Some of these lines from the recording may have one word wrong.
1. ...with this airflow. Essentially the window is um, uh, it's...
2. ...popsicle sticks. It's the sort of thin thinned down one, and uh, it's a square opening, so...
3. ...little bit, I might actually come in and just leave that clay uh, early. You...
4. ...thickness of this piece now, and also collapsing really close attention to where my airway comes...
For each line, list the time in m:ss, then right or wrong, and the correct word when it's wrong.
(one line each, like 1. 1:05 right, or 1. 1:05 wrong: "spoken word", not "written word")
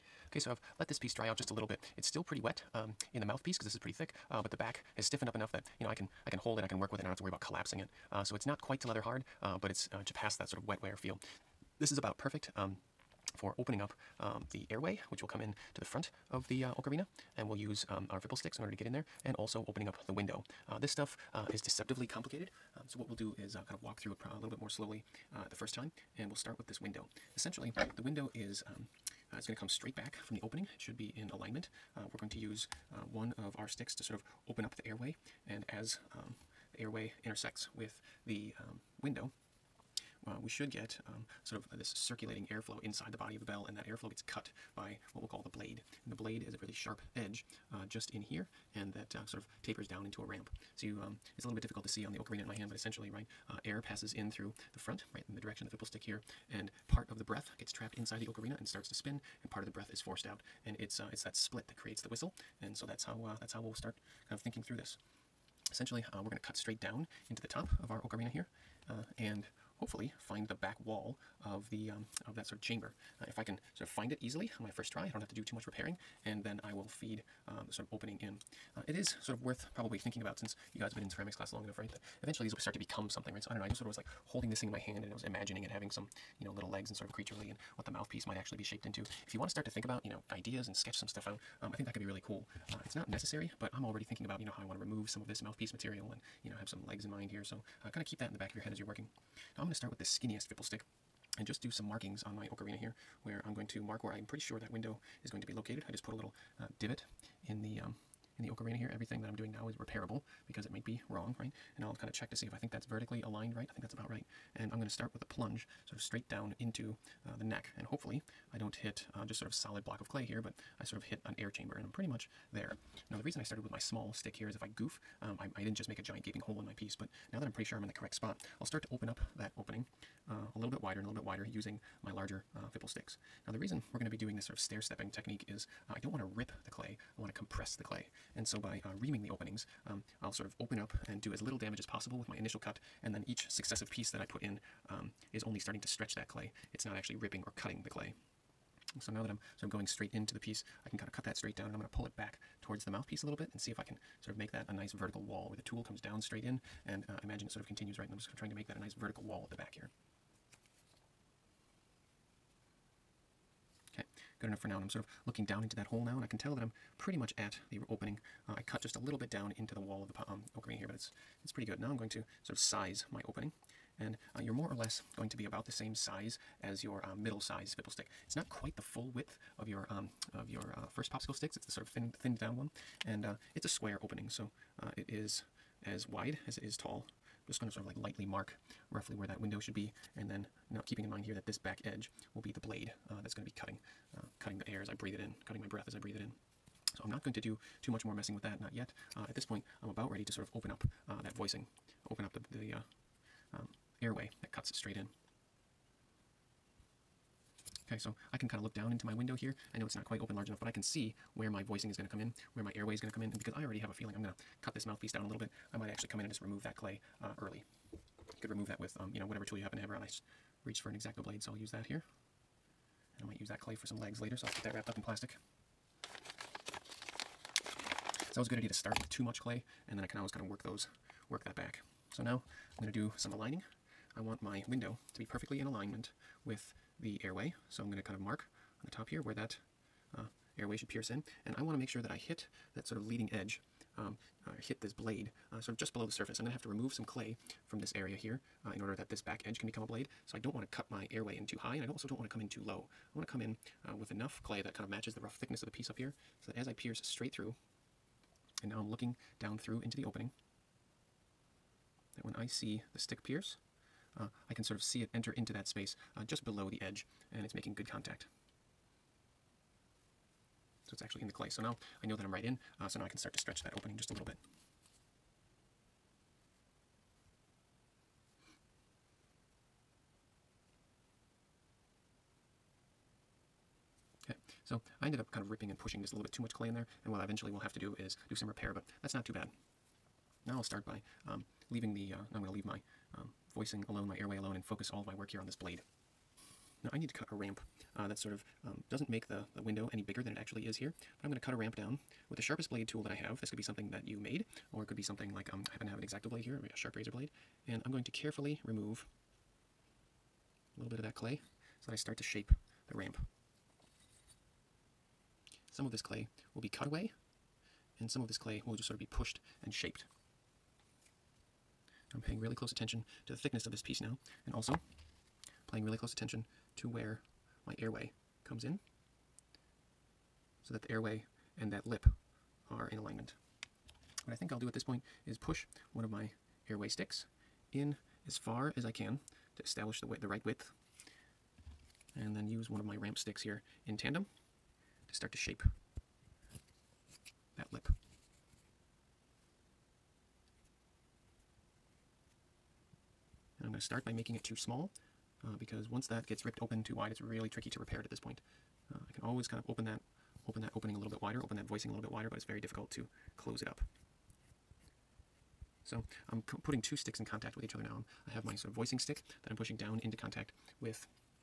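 1. 0:26 wrong: "window", not "airflow"
2. 3:01 right
3. 3:35 wrong: "remove", not "leave"
4. 5:23 wrong: "paying", not "collapsing".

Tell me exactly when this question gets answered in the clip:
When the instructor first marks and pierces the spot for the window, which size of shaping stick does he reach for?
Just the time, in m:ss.
1:40.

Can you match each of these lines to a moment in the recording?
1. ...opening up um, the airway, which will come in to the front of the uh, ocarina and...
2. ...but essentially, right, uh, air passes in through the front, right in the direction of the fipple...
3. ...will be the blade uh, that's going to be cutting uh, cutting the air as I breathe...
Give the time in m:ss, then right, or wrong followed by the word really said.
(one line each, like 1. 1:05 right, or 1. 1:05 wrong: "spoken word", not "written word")
1. 0:13 right
2. 0:52 right
3. 3:12 right.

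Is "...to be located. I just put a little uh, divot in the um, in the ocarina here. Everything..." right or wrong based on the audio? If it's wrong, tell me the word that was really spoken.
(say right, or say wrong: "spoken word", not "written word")
right.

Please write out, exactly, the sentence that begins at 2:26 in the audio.
It's not actually ripping or cutting the clay.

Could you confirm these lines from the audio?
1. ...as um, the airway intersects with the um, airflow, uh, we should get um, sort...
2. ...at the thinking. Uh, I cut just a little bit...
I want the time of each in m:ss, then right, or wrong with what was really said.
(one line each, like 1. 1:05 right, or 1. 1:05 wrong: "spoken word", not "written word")
1. 0:35 wrong: "window", not "airflow"
2. 2:47 wrong: "opening", not "thinking".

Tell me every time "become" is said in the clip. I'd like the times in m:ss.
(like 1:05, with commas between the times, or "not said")
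1:22, 4:09.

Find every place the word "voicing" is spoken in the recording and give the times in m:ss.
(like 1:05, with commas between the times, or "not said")
3:21, 3:31, 4:53, 6:01, 6:08.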